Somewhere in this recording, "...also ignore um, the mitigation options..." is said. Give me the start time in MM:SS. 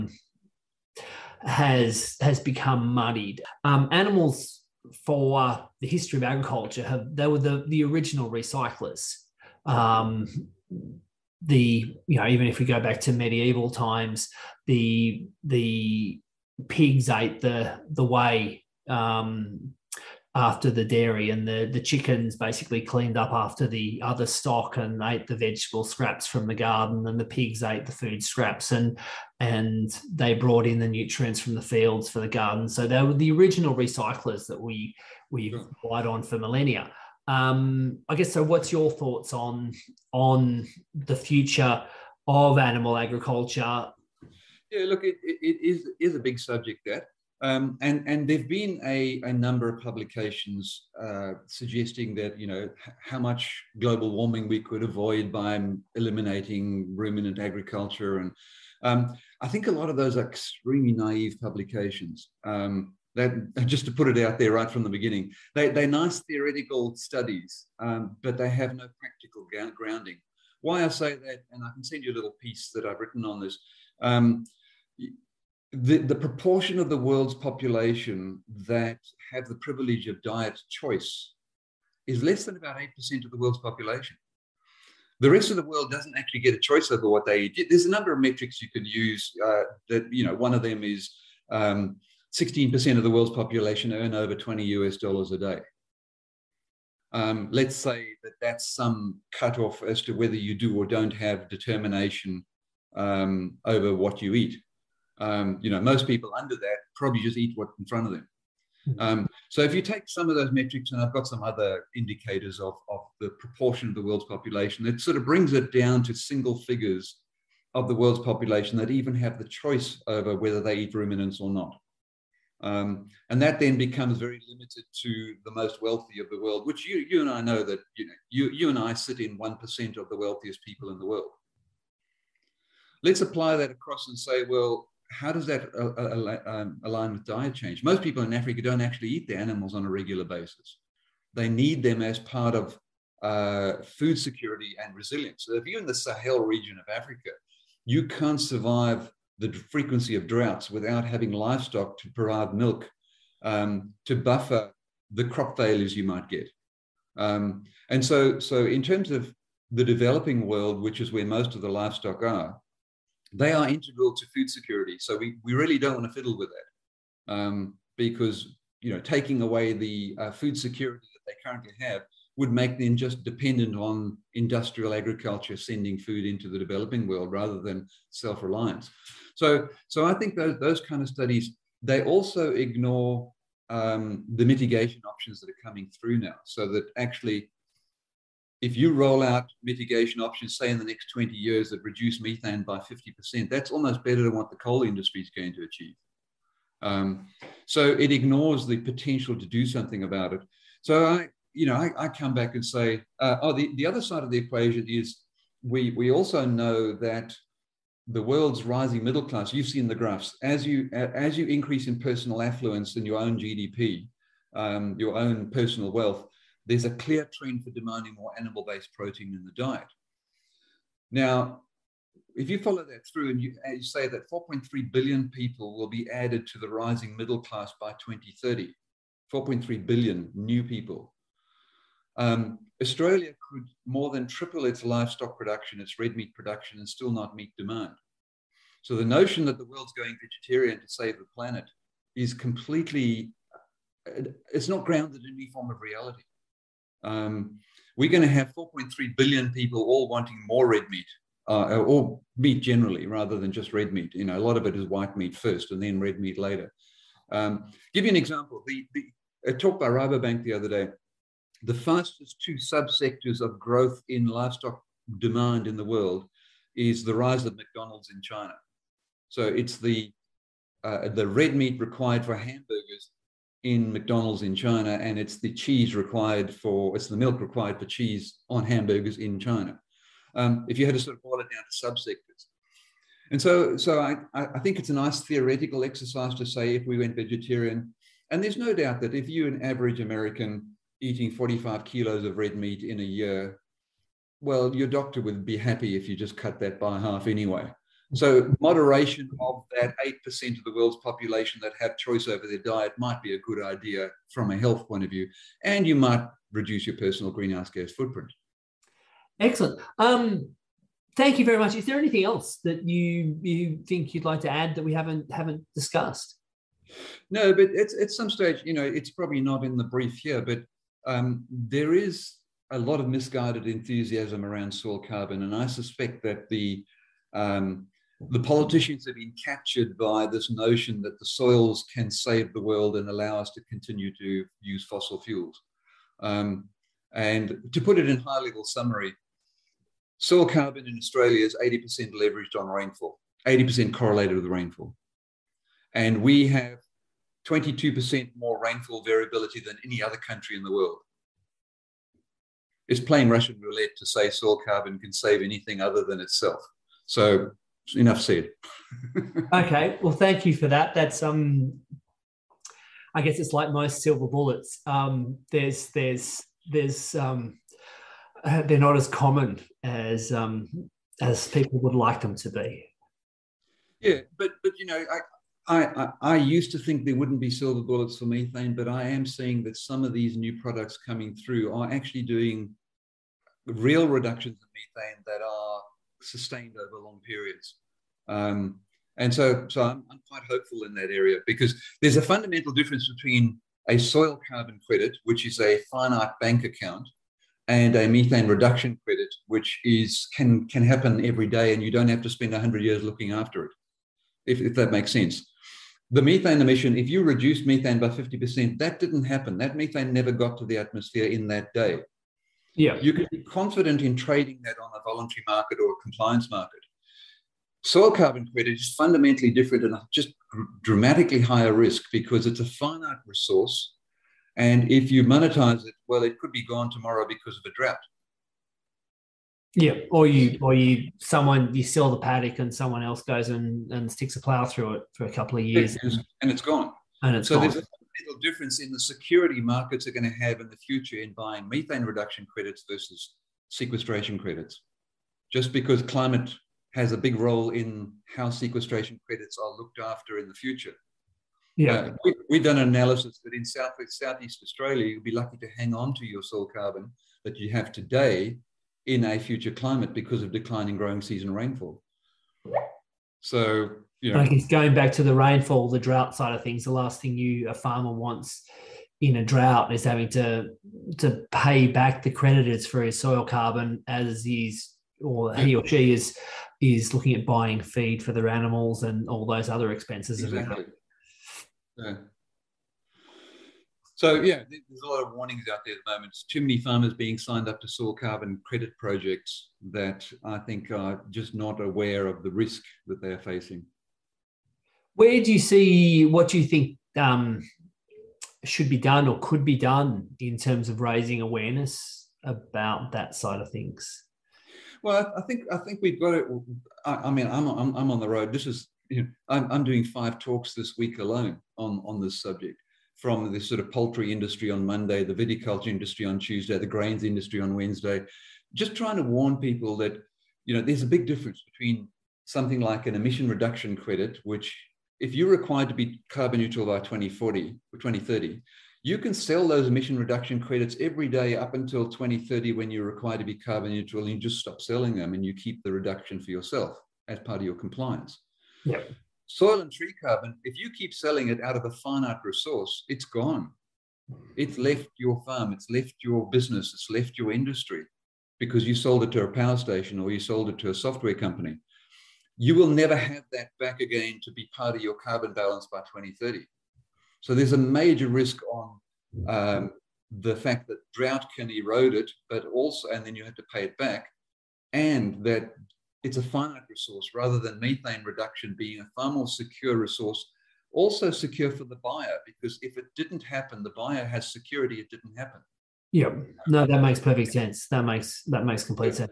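03:02.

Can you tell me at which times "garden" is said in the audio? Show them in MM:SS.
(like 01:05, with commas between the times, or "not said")
00:26, 00:32.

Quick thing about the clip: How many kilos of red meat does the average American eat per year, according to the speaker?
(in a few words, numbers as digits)
45 kilos.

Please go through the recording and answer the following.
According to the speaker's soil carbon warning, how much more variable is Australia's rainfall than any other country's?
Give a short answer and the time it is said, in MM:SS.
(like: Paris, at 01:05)
22%, at 05:47.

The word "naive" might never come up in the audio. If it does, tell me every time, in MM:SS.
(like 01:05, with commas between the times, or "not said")
01:00.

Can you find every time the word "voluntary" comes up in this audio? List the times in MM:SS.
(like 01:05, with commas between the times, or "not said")
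06:55.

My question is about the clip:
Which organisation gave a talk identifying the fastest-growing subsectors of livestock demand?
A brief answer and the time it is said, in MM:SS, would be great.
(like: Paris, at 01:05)
Rabobank, at 04:19.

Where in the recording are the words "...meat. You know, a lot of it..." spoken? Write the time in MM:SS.
04:13.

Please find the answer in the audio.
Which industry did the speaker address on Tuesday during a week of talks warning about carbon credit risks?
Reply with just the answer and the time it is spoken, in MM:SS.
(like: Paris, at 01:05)
viticulture, at 08:35.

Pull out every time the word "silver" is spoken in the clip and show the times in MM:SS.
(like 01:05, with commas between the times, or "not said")
06:04, 06:17.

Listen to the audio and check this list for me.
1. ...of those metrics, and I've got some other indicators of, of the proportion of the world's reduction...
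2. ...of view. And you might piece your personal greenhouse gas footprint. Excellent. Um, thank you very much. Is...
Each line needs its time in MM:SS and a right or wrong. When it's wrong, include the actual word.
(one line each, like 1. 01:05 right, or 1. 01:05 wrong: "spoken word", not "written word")
1. 01:50 wrong: "population", not "reduction"
2. 05:05 wrong: "reduce", not "piece".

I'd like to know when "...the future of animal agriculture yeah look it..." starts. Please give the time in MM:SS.
00:40.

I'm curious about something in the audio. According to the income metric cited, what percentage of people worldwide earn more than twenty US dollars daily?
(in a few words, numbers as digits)
16%.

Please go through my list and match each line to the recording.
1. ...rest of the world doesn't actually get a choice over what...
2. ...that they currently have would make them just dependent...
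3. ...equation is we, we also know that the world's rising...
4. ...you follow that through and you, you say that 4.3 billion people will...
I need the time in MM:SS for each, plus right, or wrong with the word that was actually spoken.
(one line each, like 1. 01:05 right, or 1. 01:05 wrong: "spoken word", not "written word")
1. 01:25 right
2. 02:51 right
3. 03:24 right
4. 03:42 right.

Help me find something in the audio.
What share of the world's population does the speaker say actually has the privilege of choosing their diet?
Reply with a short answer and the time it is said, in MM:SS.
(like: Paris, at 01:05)
less than 8%, at 01:22.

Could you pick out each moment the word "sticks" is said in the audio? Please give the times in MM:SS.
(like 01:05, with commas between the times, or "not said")
07:14.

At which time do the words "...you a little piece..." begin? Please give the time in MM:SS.
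01:12.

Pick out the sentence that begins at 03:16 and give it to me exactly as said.
Um, so it ignores the potential to do something about it.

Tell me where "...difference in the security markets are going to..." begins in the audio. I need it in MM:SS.
07:18.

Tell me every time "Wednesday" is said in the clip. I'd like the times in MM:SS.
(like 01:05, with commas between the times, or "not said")
08:37.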